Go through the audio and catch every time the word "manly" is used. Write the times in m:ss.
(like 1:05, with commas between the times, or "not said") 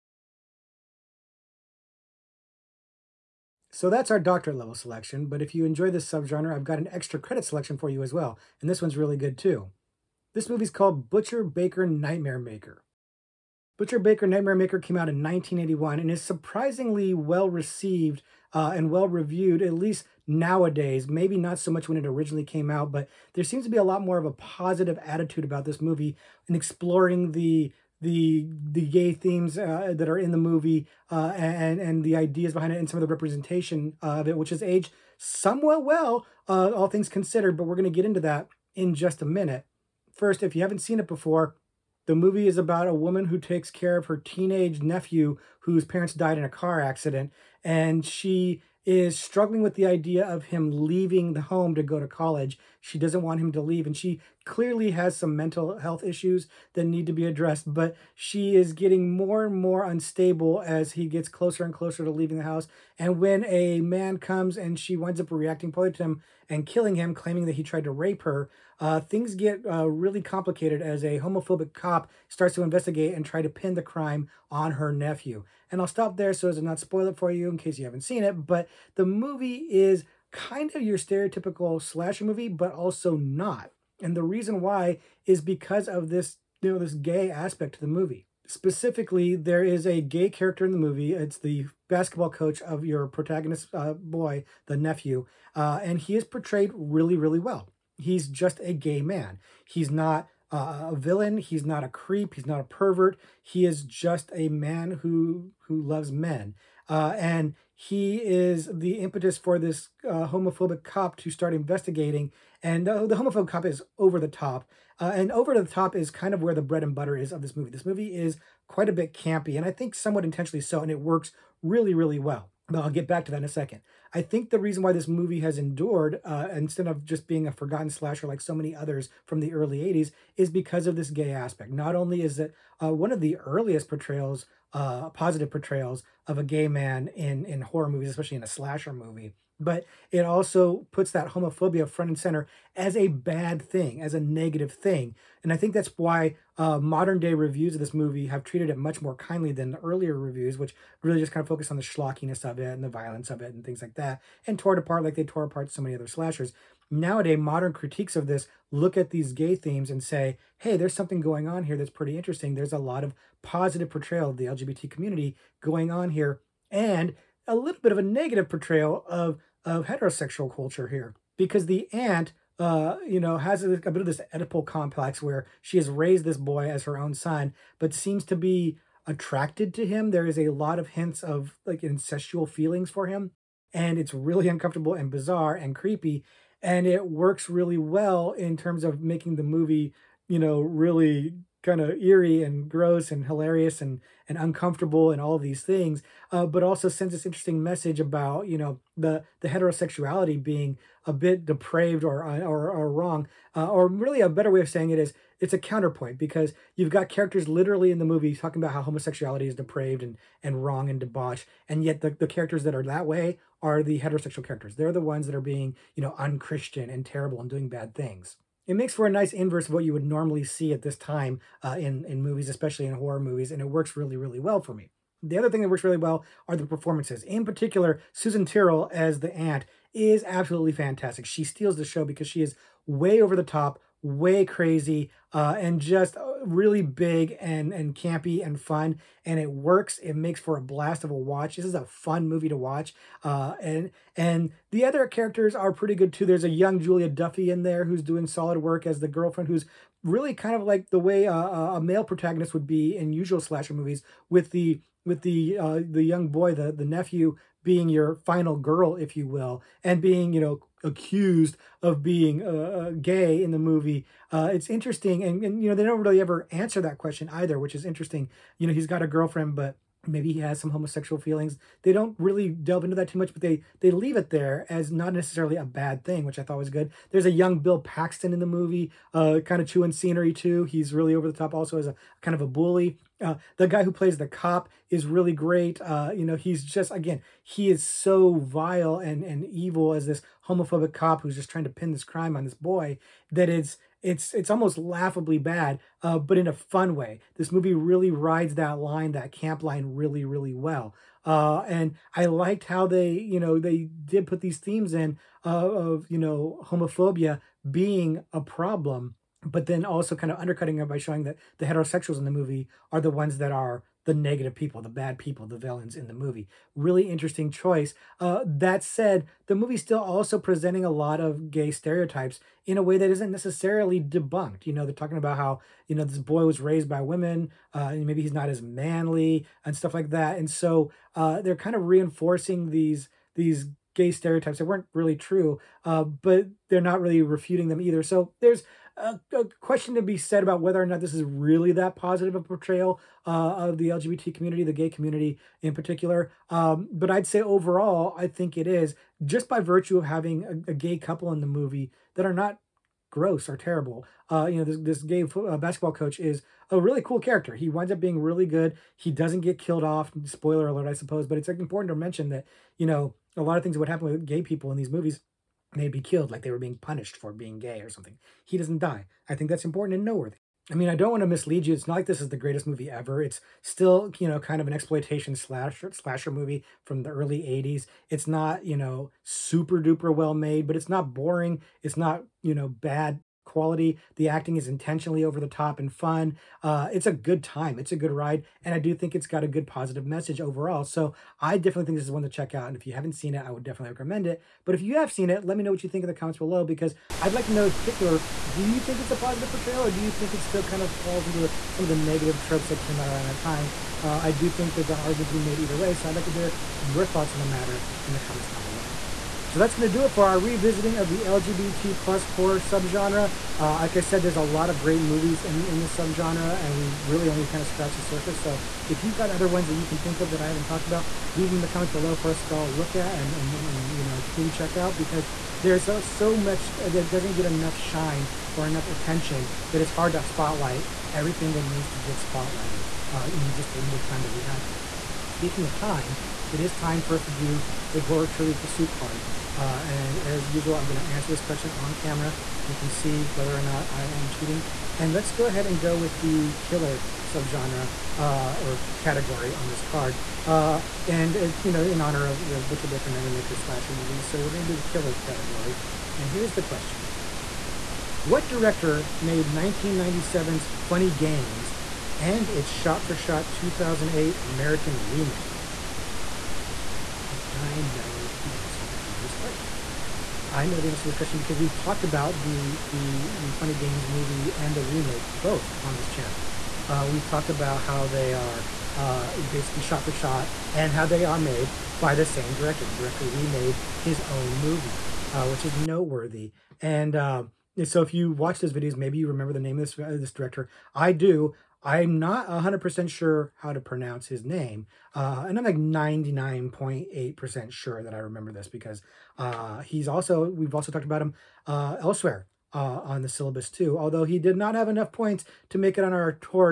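5:28.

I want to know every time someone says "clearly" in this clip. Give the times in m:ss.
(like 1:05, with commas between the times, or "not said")
0:54.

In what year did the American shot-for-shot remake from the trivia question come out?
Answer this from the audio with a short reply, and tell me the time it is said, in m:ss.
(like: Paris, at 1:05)
2008, at 7:43.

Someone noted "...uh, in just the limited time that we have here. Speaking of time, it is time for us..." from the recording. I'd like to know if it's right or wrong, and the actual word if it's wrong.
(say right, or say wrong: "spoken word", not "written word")
right.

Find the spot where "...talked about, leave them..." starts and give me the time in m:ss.
7:00.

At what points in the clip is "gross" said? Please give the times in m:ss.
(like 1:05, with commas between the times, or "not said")
3:12, 5:53.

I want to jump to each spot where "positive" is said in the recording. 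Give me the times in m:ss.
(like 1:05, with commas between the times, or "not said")
0:24, 2:15, 2:43, 5:41, 6:29, 6:39.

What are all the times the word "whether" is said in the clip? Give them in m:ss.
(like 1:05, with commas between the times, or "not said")
5:40, 7:23.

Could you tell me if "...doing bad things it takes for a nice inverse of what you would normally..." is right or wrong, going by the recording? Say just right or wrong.
wrong.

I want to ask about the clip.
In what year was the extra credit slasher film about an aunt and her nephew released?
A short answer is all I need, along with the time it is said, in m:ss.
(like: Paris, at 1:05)
1981, at 0:15.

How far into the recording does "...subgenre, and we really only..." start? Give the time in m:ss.
6:55.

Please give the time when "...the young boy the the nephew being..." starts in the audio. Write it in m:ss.
4:15.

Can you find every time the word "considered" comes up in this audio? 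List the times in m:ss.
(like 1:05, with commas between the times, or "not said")
0:37.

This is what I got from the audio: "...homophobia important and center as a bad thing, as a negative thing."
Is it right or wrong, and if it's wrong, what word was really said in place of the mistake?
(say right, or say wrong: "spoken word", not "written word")
wrong: "front", not "important".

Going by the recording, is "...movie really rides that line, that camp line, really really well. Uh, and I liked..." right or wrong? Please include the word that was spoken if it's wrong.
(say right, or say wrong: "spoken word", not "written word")
right.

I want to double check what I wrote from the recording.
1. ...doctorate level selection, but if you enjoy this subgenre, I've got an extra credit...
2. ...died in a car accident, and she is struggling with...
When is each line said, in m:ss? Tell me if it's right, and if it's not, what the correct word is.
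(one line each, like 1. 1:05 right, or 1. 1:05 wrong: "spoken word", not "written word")
1. 0:04 right
2. 0:46 right.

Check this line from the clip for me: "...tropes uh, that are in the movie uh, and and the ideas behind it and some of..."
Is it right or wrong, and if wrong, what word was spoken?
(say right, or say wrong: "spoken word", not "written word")
wrong: "themes", not "tropes".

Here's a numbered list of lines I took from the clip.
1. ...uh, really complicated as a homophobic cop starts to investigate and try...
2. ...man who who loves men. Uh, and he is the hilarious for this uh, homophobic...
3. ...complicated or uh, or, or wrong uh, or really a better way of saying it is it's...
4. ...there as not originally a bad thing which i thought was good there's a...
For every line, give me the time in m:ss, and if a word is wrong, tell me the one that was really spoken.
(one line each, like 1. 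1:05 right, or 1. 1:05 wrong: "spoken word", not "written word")
1. 1:09 right
2. 1:44 wrong: "impetus", not "hilarious"
3. 3:21 wrong: "depraved", not "complicated"
4. 4:34 wrong: "necessarily", not "originally".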